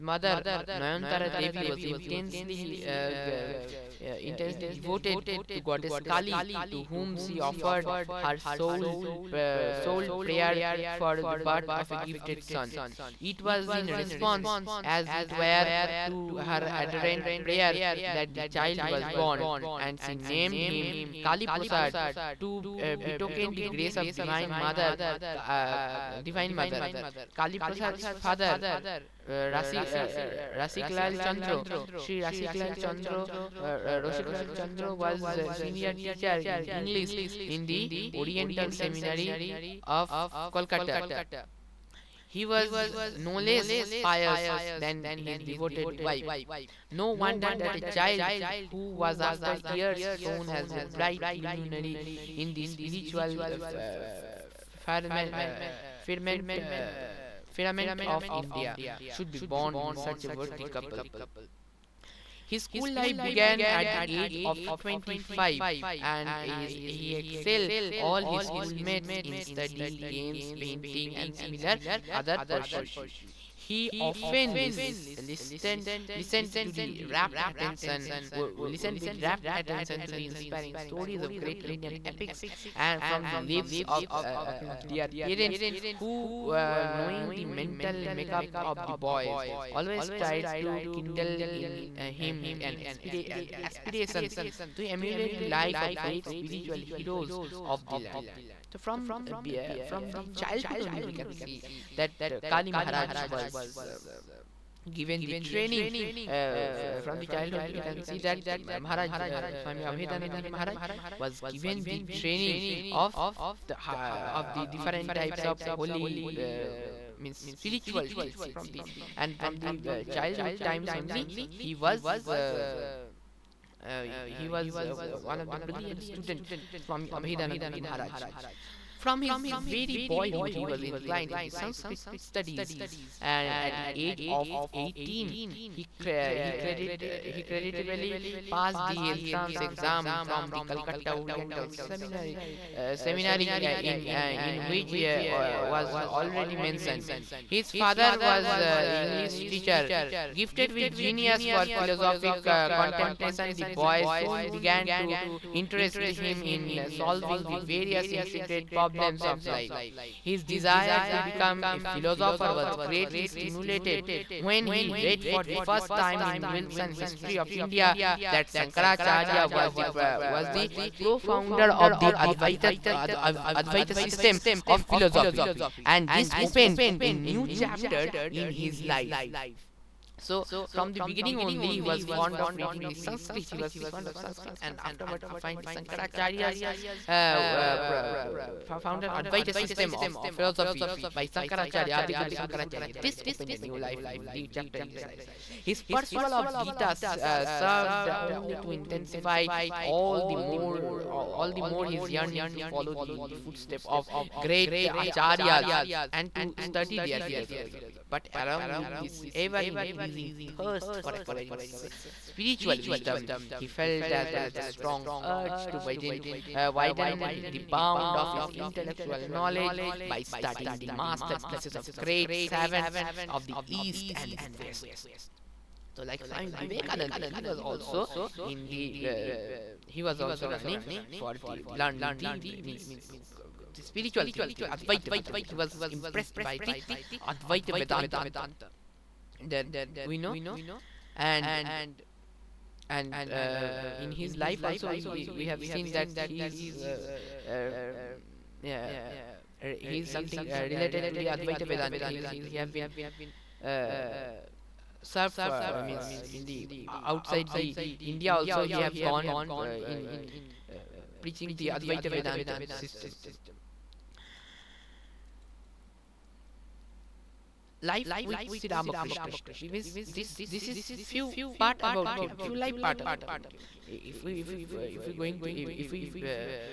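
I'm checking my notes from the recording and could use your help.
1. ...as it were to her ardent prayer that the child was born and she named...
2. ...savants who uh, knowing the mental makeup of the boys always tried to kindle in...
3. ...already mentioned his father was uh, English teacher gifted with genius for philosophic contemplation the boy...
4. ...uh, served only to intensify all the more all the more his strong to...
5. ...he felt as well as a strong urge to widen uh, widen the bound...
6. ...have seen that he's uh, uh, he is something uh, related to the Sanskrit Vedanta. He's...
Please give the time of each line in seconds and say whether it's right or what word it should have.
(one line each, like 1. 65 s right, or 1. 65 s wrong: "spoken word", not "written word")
1. 14 s right
2. 85 s wrong: "parents", not "savants"
3. 146 s right
4. 197 s wrong: "yearning", not "strong"
5. 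213 s right
6. 245 s wrong: "Advaita", not "Sanskrit".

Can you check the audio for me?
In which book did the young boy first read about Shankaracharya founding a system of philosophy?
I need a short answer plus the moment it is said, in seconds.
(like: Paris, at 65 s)
Wilson's History of India, at 166 s.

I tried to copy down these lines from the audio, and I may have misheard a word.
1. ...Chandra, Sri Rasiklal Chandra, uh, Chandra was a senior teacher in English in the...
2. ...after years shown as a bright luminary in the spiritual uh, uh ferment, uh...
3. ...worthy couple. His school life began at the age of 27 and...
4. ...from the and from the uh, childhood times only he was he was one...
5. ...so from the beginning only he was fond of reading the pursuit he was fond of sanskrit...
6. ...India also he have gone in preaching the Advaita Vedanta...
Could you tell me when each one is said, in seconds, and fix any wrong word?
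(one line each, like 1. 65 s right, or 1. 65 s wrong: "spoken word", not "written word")
1. 31 s right
2. 49 s right
3. 60 s wrong: "25", not "27"
4. 118 s right
5. 180 s wrong: "sanskrit", not "pursuit"
6. 258 s right.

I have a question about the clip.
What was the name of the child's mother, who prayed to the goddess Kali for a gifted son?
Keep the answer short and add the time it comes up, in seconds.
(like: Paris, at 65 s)
Nayantara Devi, at 0 s.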